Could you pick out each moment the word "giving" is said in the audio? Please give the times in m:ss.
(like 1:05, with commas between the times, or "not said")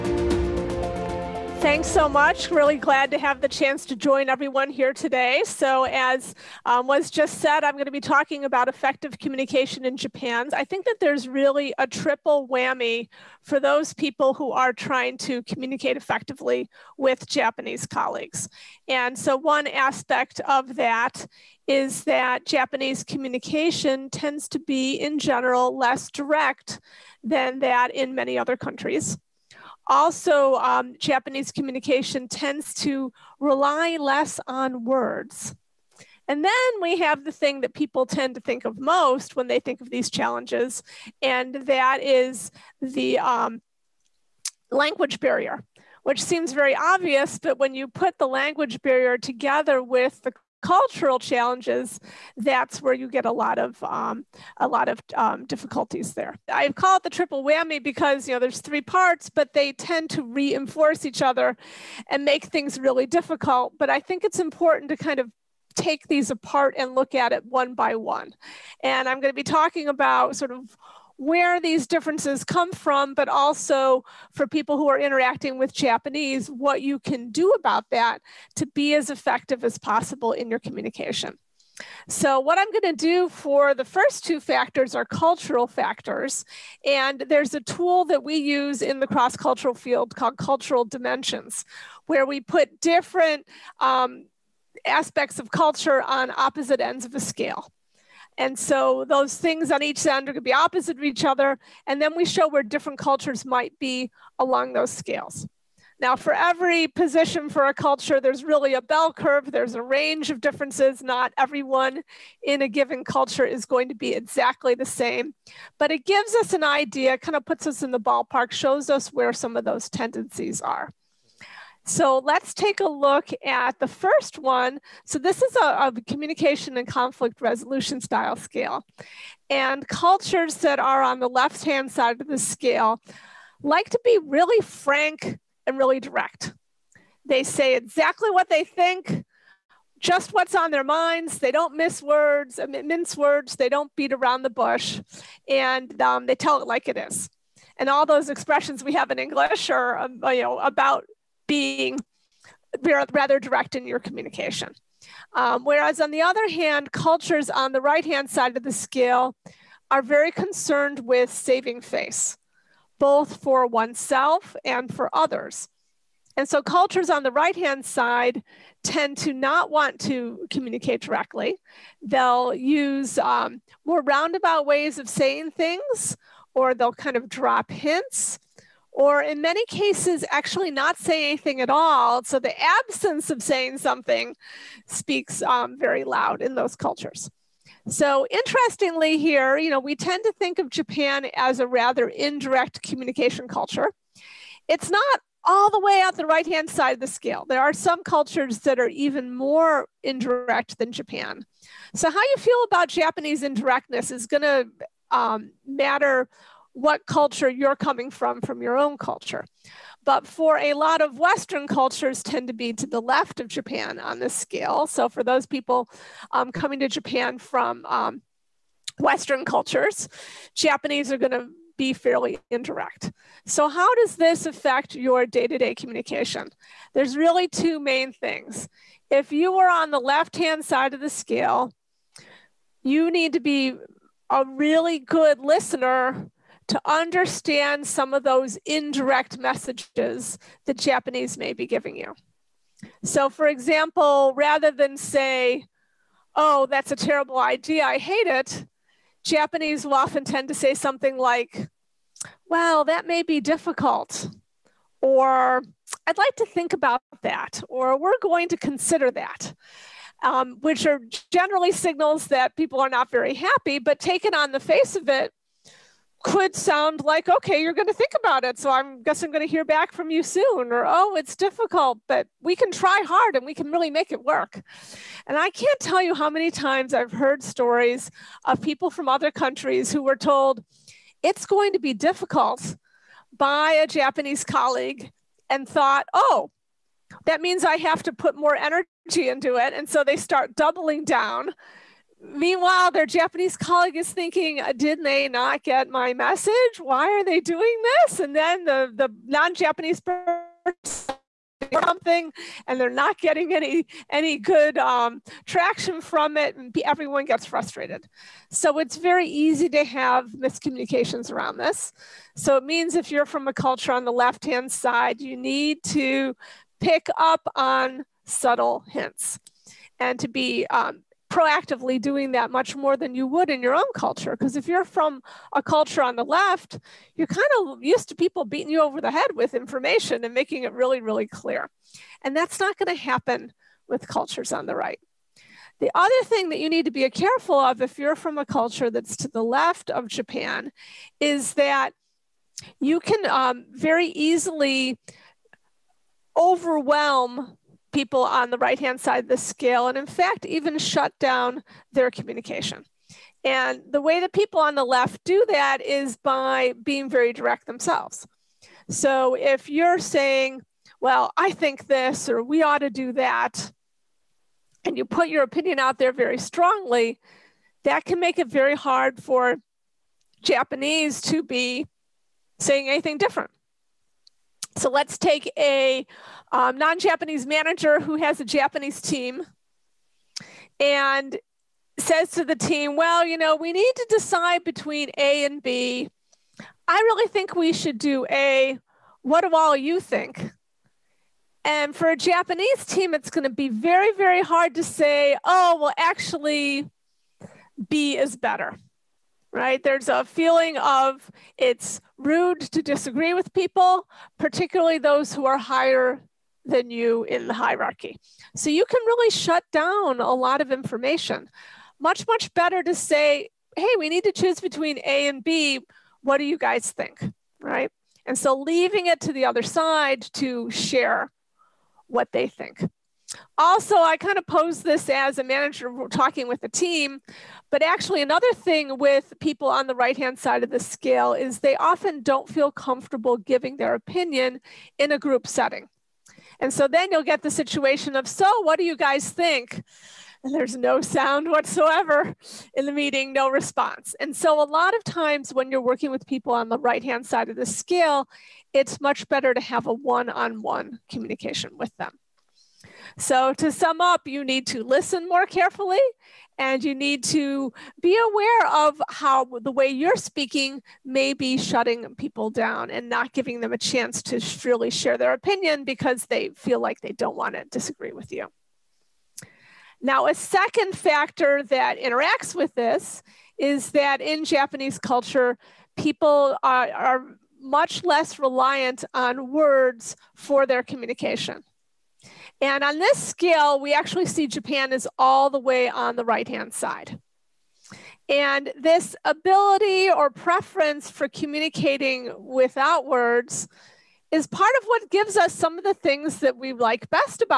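4:01, 7:13, 7:43.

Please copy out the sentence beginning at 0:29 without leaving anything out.
Also, um, Japanese communication tends to rely less on words.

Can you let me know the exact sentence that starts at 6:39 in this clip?
There's a feeling of it's rude to disagree with people, particularly those who are higher than you in the hierarchy.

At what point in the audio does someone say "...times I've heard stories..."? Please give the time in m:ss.
4:36.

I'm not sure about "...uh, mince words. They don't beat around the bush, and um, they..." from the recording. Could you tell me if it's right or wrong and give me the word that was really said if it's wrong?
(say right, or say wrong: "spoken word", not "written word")
right.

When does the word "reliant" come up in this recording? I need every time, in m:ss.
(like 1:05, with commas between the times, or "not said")
7:58.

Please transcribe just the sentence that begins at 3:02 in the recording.
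So the absence of saying something speaks um, very loud in those cultures.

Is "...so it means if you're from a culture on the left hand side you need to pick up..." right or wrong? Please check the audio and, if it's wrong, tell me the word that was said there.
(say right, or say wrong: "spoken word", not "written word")
right.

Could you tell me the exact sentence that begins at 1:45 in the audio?
Now, for every position for a culture, there's really a bell curve.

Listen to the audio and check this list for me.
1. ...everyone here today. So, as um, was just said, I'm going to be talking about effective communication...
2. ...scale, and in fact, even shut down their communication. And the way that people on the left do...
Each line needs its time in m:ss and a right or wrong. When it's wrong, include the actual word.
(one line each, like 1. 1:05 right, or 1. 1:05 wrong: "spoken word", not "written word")
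1. 0:04 right
2. 5:49 right.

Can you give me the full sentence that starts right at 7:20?
And there's no sound whatsoever in the meeting, no response.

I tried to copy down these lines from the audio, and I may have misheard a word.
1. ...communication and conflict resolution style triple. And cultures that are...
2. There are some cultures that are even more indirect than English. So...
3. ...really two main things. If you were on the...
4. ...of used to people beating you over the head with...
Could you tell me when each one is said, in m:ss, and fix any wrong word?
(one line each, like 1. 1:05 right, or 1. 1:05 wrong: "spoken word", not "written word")
1. 2:06 wrong: "scale", not "triple"
2. 3:17 wrong: "Japan", not "English"
3. 3:47 right
4. 5:27 right.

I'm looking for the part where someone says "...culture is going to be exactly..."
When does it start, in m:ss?
1:53.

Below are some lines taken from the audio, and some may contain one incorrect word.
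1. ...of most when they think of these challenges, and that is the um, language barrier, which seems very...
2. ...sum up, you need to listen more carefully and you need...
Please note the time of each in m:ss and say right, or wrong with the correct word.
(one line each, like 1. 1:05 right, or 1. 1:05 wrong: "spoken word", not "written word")
1. 0:38 right
2. 7:33 right.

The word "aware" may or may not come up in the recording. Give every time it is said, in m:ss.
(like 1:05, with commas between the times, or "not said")
7:38.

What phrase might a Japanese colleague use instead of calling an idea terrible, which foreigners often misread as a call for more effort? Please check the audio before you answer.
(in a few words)
That may be difficult.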